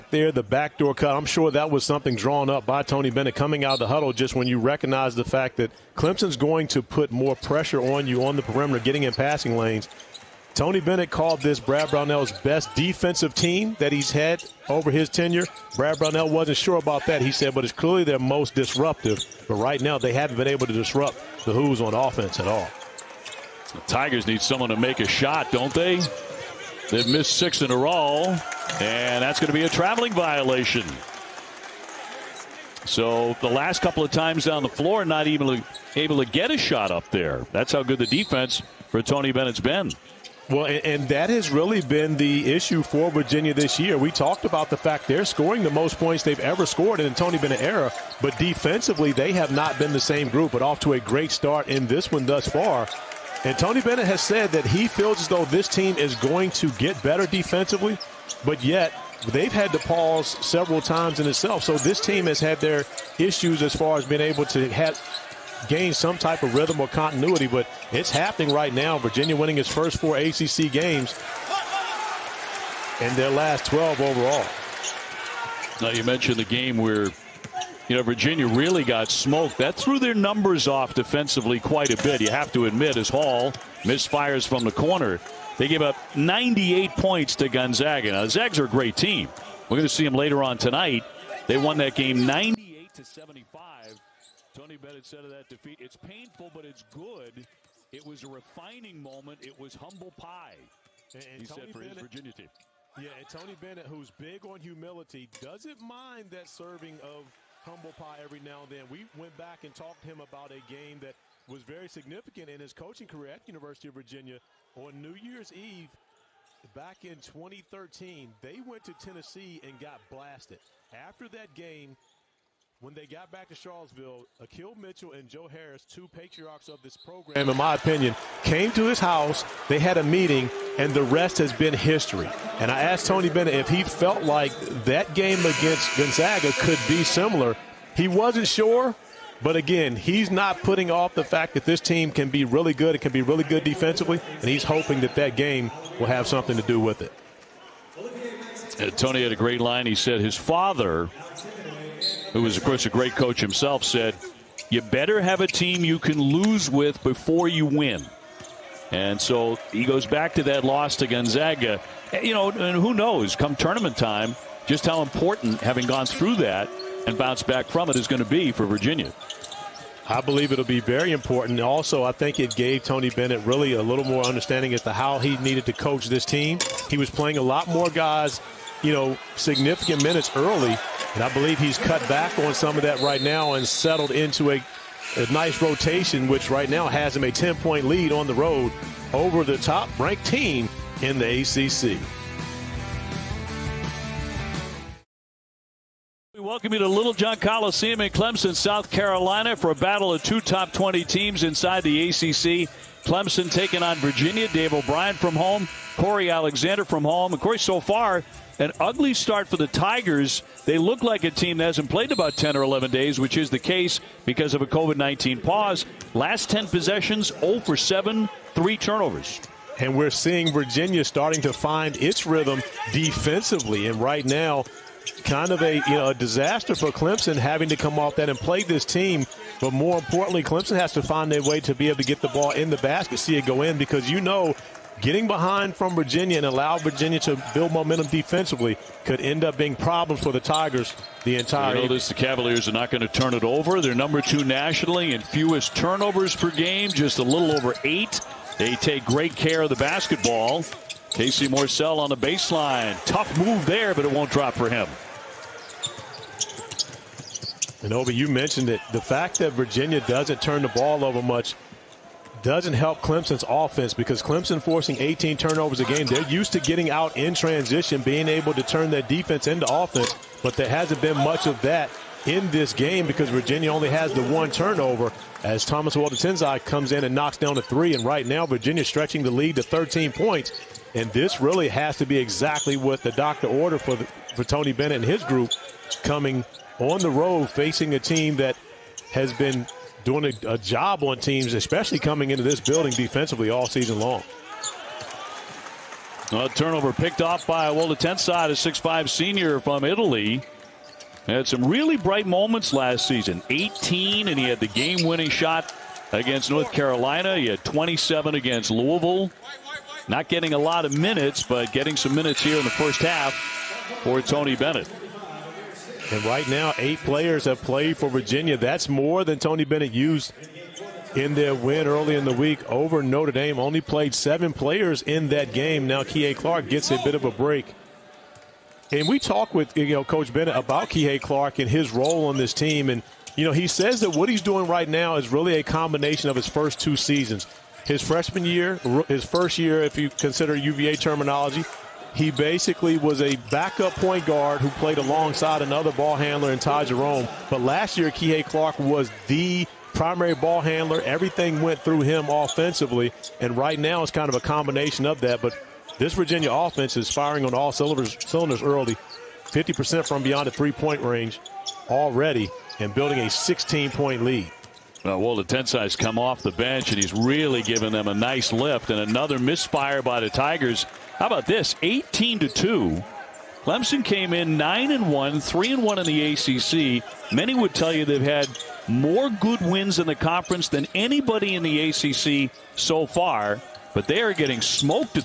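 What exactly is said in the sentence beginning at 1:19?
That threw their numbers off defensively quite a bit.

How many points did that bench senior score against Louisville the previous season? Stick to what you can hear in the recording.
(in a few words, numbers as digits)
27.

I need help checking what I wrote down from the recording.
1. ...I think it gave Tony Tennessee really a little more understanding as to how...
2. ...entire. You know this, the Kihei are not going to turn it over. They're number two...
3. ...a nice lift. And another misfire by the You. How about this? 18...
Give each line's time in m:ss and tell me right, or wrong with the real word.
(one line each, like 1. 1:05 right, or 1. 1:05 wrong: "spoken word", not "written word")
1. 2:52 wrong: "Bennett", not "Tennessee"
2. 4:01 wrong: "Cavaliers", not "Kihei"
3. 6:08 wrong: "Tigers", not "You".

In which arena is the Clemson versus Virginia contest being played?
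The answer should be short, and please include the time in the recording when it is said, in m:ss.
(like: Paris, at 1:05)
Littlejohn Coliseum, at 3:16.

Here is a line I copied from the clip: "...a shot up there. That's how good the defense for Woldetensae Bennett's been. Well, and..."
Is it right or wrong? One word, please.
wrong.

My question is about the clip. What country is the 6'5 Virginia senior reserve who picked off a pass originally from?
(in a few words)
Italy.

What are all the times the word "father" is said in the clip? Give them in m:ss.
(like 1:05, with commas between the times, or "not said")
2:30.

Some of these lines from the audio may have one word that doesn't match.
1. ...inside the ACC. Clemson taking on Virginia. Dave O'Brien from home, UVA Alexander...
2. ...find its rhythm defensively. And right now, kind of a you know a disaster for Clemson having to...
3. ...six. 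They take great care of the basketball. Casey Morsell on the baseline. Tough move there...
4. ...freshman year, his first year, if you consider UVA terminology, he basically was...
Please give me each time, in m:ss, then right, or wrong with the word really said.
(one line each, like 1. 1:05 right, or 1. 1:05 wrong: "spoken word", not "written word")
1. 3:21 wrong: "Corey", not "UVA"
2. 3:41 right
3. 4:07 wrong: "eight", not "six"
4. 5:38 right.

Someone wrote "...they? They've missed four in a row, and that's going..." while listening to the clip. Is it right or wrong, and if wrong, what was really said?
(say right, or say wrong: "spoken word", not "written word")
wrong: "six", not "four".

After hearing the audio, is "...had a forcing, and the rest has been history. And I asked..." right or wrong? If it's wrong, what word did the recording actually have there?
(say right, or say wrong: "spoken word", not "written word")
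wrong: "meeting", not "forcing".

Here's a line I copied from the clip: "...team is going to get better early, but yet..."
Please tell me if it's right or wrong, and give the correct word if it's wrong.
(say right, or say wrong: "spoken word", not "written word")
wrong: "defensively", not "early".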